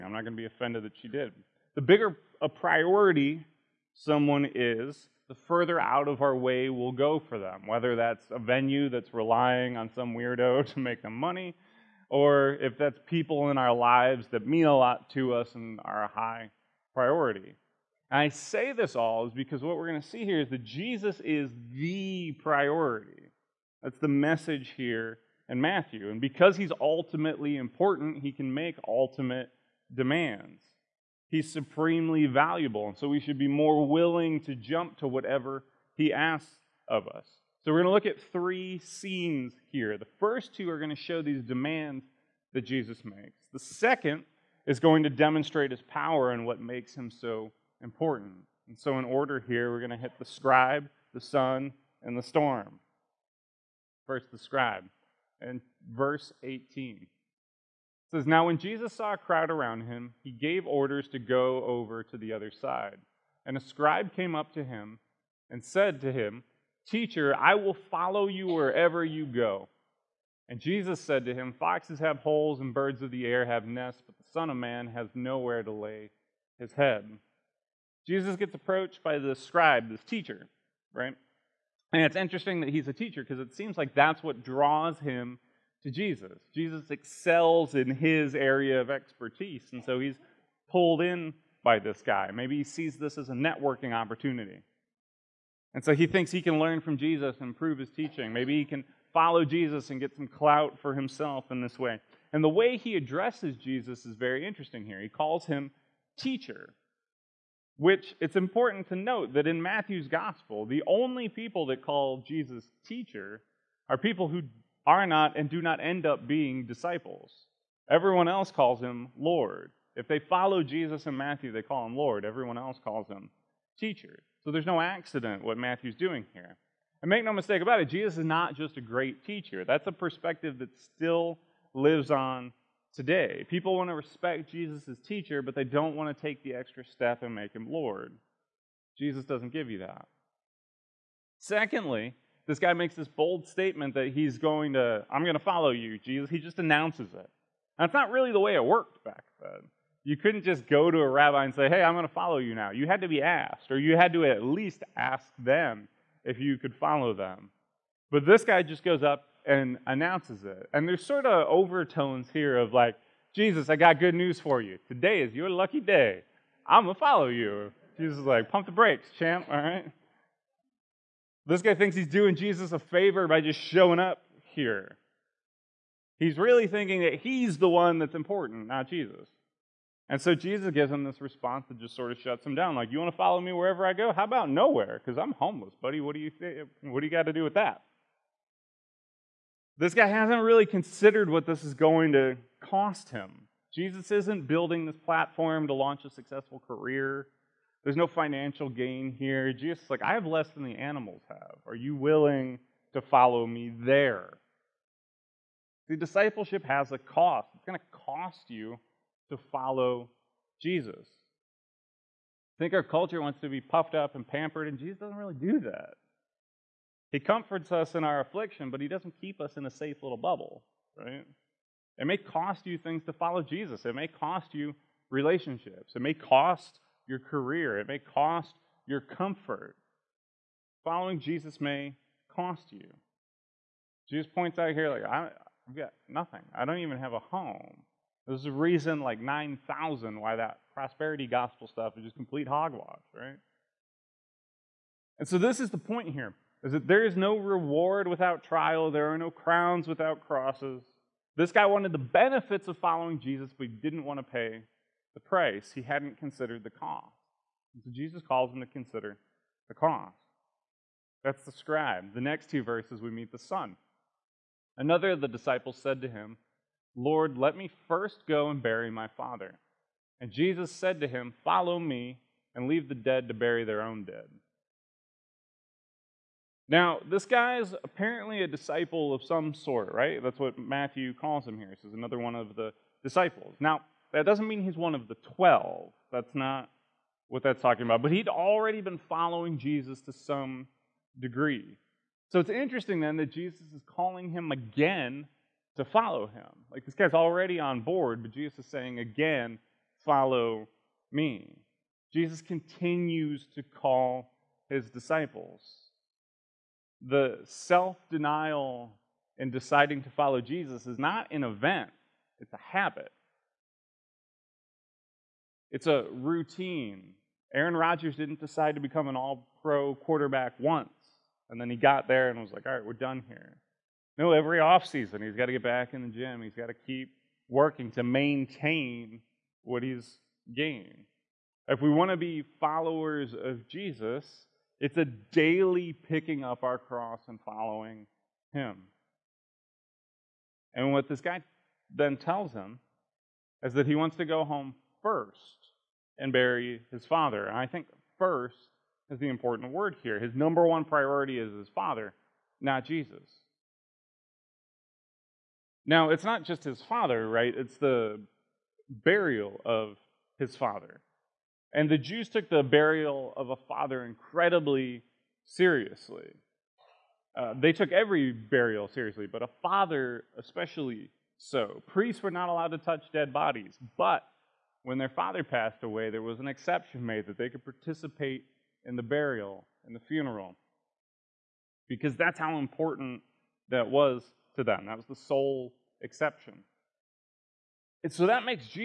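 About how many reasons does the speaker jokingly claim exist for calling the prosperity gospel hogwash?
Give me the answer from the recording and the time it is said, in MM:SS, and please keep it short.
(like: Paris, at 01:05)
9,000, at 03:59.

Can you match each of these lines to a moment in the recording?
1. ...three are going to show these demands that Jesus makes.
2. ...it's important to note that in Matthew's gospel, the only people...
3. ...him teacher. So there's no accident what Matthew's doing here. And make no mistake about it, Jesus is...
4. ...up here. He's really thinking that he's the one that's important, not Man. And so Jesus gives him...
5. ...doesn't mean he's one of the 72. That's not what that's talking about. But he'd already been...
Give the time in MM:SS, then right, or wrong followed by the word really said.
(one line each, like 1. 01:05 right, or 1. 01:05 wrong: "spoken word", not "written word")
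1. 00:40 wrong: "two", not "three"
2. 01:48 right
3. 02:03 right
4. 02:53 wrong: "Jesus", not "Man"
5. 04:44 wrong: "12", not "72".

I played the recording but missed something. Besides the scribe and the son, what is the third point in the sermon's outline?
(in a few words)
The storm.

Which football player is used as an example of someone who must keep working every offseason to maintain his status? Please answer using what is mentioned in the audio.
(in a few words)
Aaron Rodgers.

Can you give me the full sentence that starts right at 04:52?
So it's interesting then that Jesus is calling him again to follow him.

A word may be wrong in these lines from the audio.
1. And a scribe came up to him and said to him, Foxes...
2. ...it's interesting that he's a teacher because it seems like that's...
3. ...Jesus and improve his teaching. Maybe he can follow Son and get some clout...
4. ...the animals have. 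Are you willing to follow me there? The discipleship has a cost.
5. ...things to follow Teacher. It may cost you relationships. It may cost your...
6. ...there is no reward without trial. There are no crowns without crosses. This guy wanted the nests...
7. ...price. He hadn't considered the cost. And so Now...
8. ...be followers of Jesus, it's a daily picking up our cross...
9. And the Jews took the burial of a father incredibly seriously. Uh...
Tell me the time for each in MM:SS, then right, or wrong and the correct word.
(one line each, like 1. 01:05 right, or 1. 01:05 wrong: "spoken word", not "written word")
1. 01:03 wrong: "Teacher", not "Foxes"
2. 01:22 right
3. 01:36 wrong: "Jesus", not "Son"
4. 03:20 right
5. 03:42 wrong: "Jesus", not "Teacher"
6. 04:06 wrong: "benefits", not "nests"
7. 04:15 wrong: "Jesus", not "Now"
8. 05:32 right
9. 06:01 right.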